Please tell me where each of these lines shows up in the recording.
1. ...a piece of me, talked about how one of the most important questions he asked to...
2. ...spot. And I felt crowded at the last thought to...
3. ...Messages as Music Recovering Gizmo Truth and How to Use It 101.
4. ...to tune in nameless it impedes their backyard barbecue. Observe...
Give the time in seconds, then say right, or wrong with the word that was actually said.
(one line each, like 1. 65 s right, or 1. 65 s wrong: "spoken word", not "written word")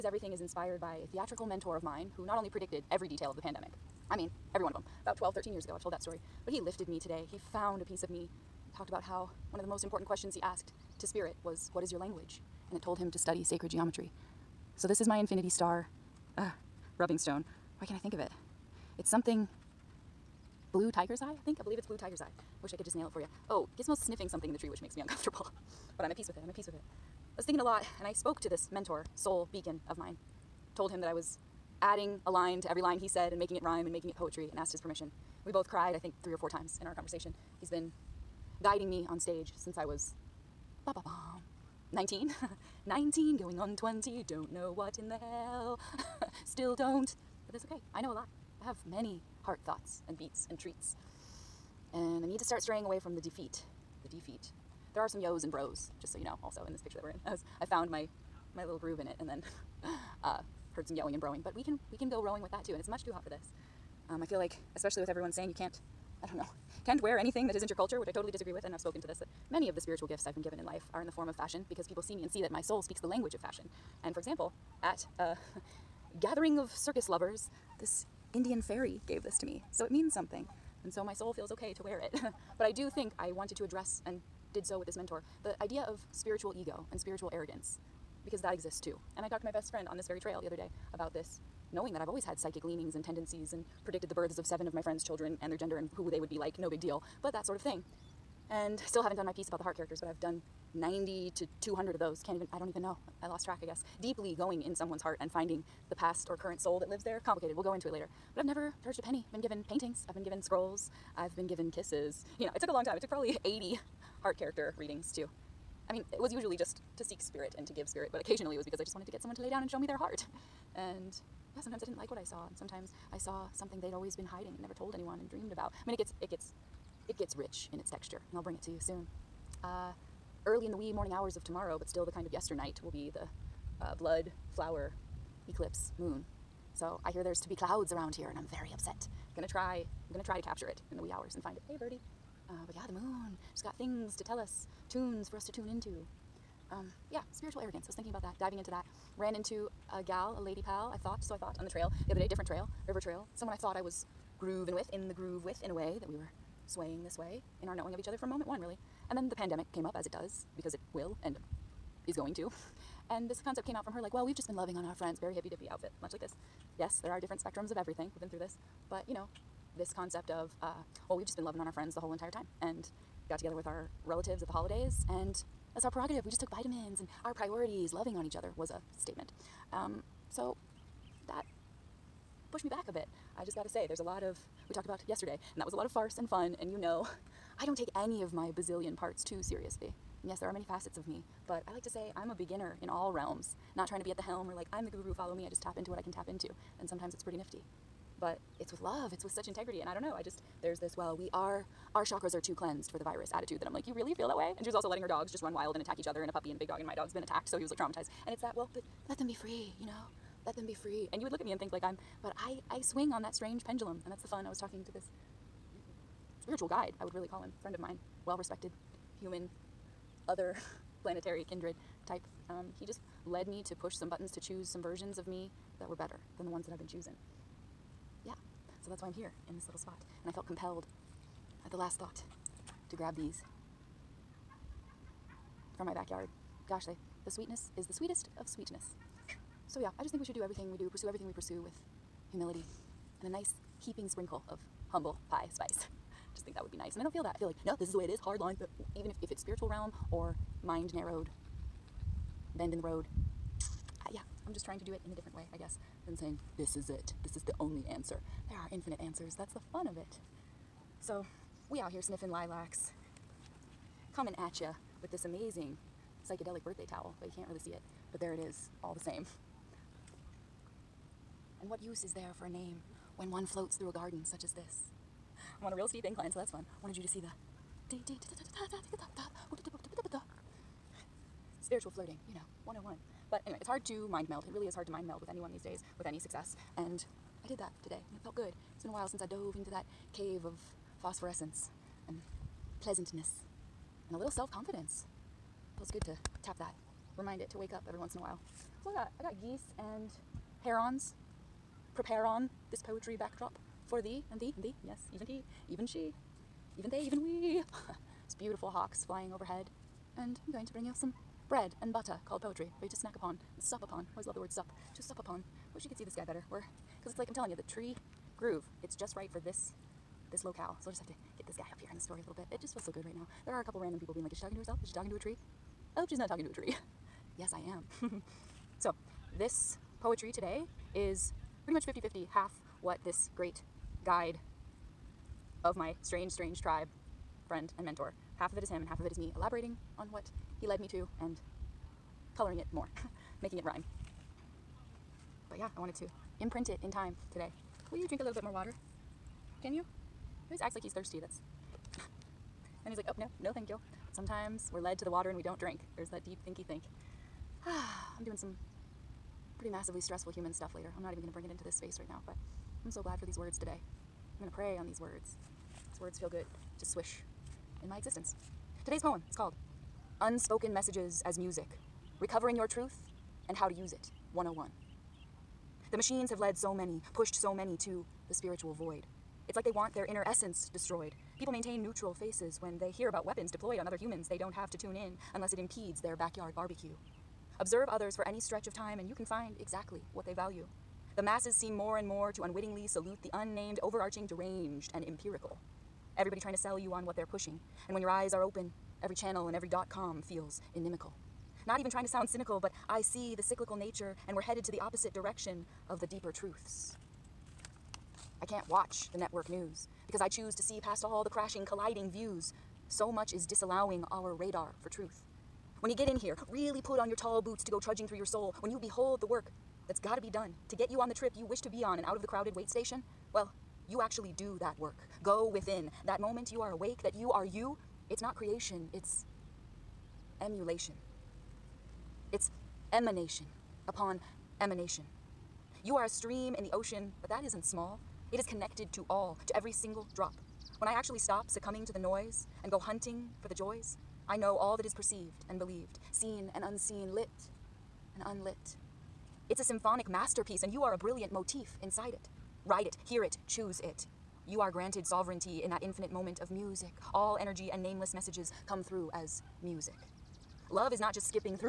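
1. 7 s right
2. 229 s wrong: "compelled", not "crowded"
3. 370 s wrong: "Your", not "Gizmo"
4. 384 s wrong: "unless", not "nameless".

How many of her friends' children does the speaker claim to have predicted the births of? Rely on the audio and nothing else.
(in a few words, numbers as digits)
7.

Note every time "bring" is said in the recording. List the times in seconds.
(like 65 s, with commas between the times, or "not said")
128 s, 310 s, 361 s.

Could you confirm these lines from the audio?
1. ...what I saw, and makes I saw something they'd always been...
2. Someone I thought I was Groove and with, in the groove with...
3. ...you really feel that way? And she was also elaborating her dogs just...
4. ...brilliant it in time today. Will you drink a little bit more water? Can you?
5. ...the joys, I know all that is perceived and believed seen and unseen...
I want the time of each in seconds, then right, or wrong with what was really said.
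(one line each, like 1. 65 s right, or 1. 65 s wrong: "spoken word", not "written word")
1. 122 s wrong: "sometimes", not "makes"
2. 153 s right
3. 203 s wrong: "letting", not "elaborating"
4. 346 s wrong: "imprint", not "brilliant"
5. 443 s right.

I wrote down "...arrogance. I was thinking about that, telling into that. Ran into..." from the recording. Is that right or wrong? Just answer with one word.
wrong.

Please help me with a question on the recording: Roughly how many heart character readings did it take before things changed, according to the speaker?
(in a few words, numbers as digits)
80.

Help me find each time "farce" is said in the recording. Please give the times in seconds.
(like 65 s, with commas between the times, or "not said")
185 s.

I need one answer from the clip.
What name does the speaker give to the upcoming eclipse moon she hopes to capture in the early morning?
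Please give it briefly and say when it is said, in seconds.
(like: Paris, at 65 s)
blood flower eclipse moon, at 133 s.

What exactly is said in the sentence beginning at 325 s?
I hope she's not talking to a tree.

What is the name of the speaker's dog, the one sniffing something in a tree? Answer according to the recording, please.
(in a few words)
Gizmo.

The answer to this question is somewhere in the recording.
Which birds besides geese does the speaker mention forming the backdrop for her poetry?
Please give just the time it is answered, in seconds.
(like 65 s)
300 s.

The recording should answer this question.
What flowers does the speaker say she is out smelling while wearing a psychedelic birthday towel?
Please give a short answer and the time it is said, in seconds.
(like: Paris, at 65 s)
lilacs, at 262 s.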